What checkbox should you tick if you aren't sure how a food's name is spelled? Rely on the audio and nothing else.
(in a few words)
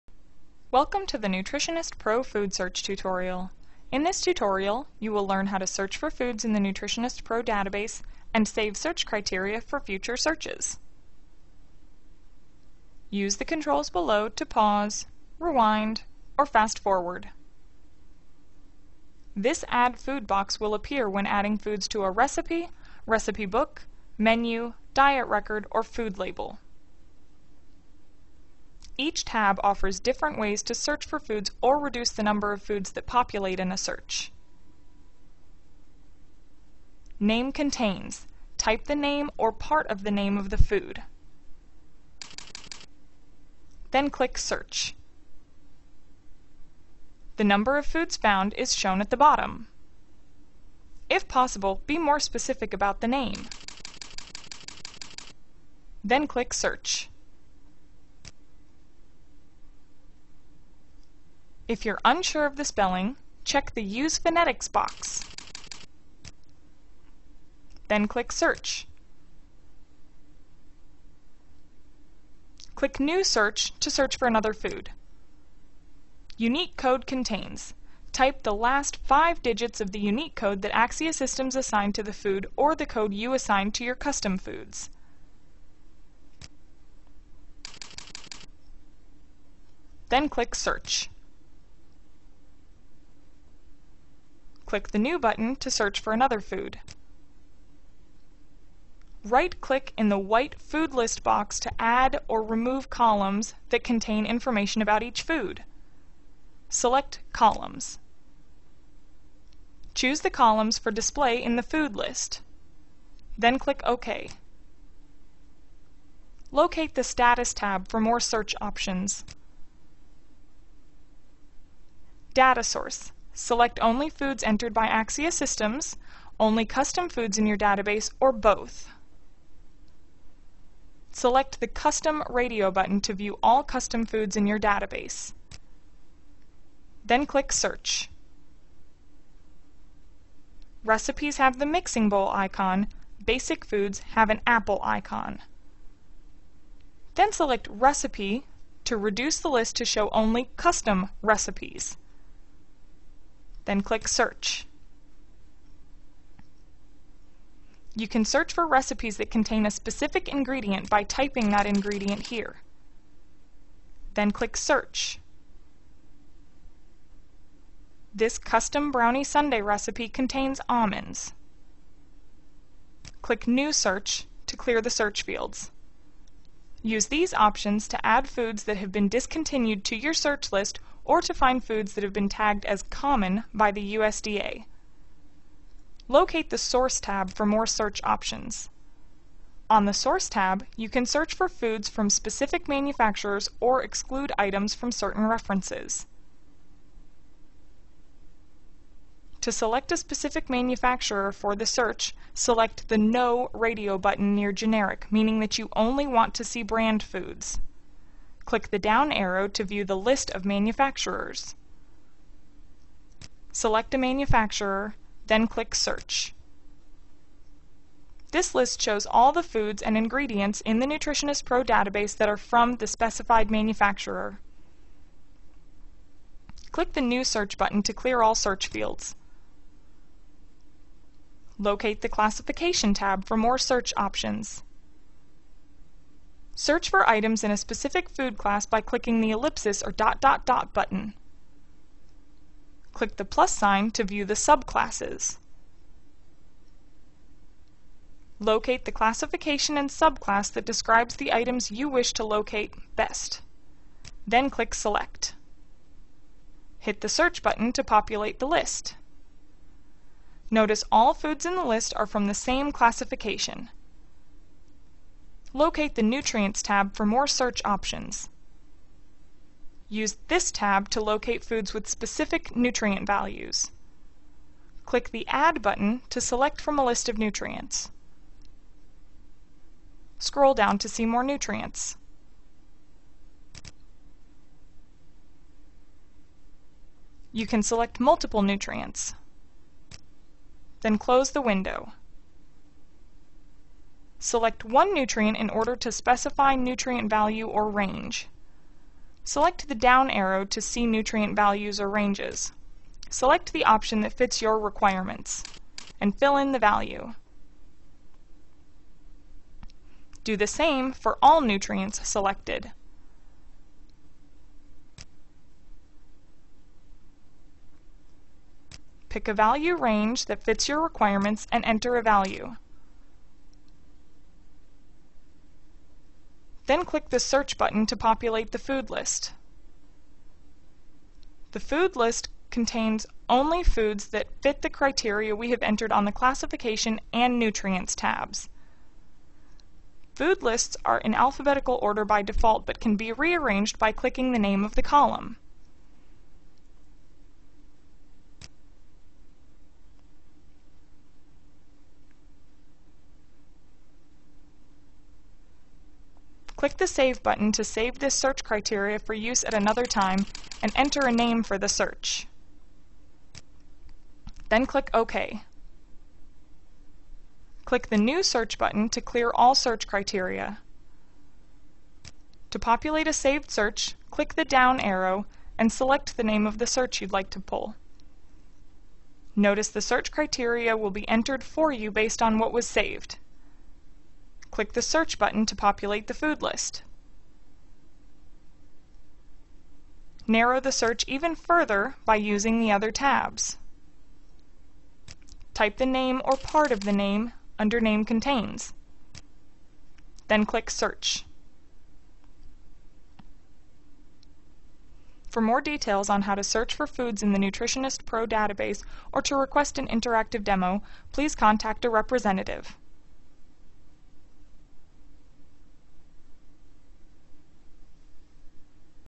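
Use Phonetics.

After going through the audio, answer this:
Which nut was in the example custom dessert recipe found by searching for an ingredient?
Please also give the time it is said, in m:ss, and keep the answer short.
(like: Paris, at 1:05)
almonds, at 2:50.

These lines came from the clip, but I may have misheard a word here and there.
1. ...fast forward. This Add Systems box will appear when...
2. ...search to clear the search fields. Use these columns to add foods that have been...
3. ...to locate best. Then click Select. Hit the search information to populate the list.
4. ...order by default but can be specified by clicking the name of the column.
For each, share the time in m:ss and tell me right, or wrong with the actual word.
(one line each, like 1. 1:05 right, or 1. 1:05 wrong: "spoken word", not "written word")
1. 0:16 wrong: "Food", not "Systems"
2. 2:53 wrong: "options", not "columns"
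3. 4:12 wrong: "button", not "information"
4. 5:41 wrong: "rearranged", not "specified".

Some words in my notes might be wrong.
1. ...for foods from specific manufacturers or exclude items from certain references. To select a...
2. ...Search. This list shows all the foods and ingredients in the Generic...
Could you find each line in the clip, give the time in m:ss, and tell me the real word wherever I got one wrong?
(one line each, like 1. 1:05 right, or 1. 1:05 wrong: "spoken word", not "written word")
1. 3:11 right
2. 3:35 wrong: "Nutritionist", not "Generic".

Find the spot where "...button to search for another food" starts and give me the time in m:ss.
1:35.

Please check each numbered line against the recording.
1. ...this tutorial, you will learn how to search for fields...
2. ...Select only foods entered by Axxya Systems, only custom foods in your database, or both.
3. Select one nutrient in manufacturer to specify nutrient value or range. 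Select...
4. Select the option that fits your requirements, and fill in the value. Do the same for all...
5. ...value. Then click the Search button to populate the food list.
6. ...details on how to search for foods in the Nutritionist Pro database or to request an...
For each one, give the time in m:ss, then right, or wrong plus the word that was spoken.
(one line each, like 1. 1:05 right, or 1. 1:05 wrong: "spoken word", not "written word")
1. 0:04 wrong: "foods", not "fields"
2. 2:03 right
3. 4:54 wrong: "order", not "manufacturer"
4. 5:03 right
5. 5:22 right
6. 6:45 right.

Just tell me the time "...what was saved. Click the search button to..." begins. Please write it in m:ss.
6:22.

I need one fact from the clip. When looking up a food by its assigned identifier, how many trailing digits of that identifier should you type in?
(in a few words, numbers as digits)
5.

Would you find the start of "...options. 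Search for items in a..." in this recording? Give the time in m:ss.
3:53.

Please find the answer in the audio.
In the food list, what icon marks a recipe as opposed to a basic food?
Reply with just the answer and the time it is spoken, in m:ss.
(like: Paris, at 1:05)
mixing bowl, at 2:21.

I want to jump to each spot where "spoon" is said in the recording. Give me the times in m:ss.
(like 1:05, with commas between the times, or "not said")
not said.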